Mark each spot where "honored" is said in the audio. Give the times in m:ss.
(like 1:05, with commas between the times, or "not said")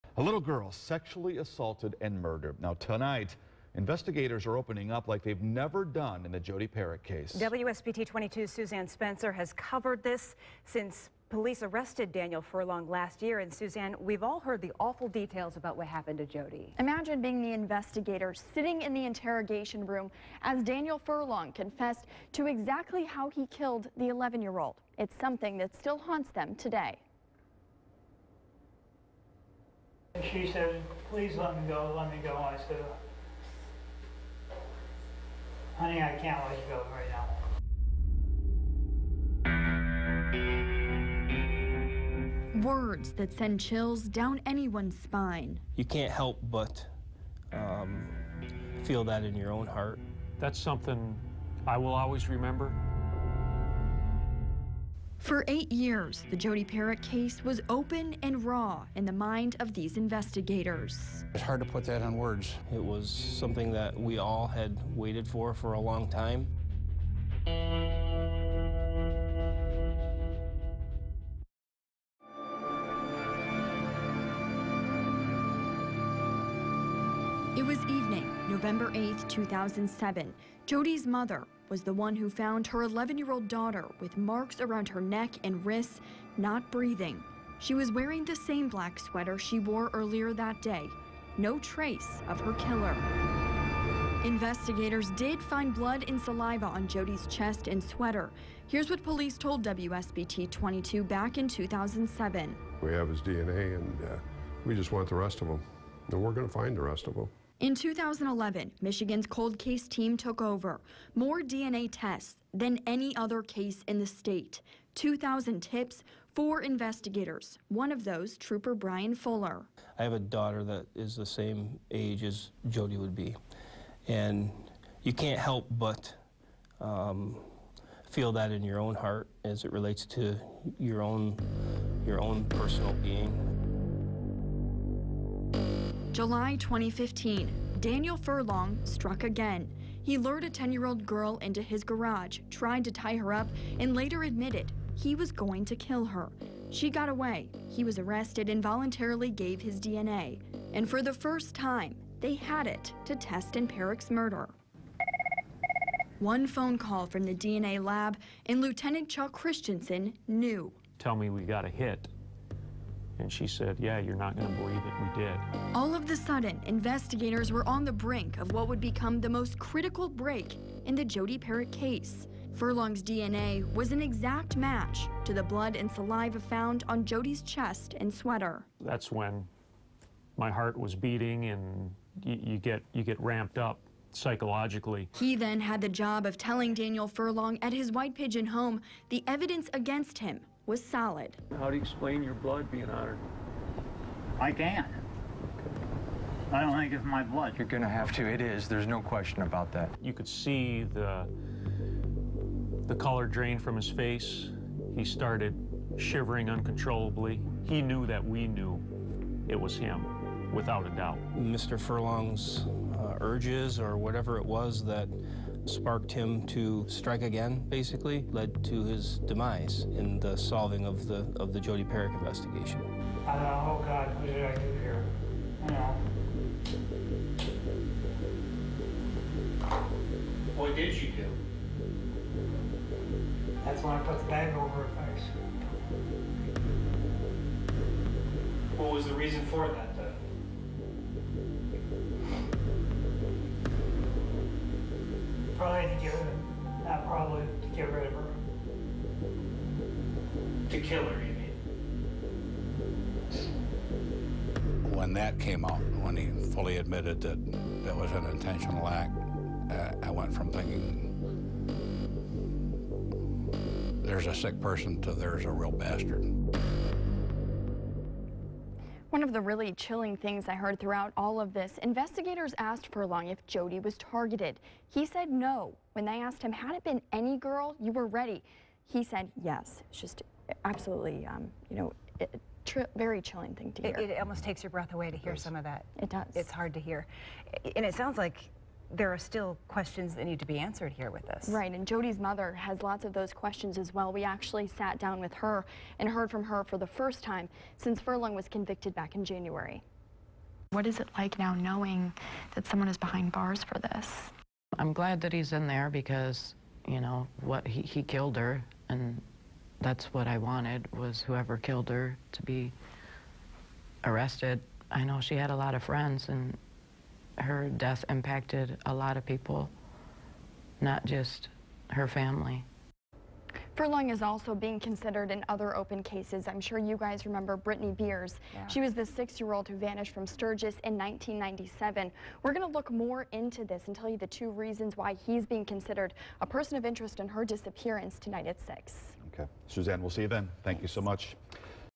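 3:12.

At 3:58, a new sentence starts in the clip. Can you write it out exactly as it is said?
What was the reason for that?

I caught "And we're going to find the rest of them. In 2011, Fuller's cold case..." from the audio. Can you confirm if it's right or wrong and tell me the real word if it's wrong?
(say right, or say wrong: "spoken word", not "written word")
wrong: "Michigan", not "Fuller".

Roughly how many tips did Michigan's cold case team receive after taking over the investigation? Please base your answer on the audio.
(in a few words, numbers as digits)
2,000.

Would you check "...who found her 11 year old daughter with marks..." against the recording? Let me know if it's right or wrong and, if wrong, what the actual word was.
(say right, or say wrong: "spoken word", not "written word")
right.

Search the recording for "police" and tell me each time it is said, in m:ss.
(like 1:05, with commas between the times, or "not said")
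0:11, 1:39.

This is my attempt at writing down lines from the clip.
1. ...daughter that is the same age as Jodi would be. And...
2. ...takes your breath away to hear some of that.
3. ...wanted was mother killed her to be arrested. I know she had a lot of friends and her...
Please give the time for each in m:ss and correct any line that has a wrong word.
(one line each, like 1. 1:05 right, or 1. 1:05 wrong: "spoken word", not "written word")
1. 2:00 right
2. 4:44 right
3. 5:10 wrong: "whoever", not "mother".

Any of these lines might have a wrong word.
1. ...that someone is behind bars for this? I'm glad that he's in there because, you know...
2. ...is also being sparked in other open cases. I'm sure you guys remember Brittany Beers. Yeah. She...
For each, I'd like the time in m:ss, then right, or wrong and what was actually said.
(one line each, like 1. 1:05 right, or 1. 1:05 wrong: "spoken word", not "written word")
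1. 5:02 right
2. 5:24 wrong: "considered", not "sparked".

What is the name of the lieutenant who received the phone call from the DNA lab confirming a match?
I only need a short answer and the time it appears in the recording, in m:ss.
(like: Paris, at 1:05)
Chuck Christensen, at 2:39.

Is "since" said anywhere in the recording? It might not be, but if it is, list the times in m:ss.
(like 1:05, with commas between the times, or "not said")
0:10, 4:57.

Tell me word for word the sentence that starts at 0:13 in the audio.
And Suzanne, we've all heard the awful details about what happened to Jodi.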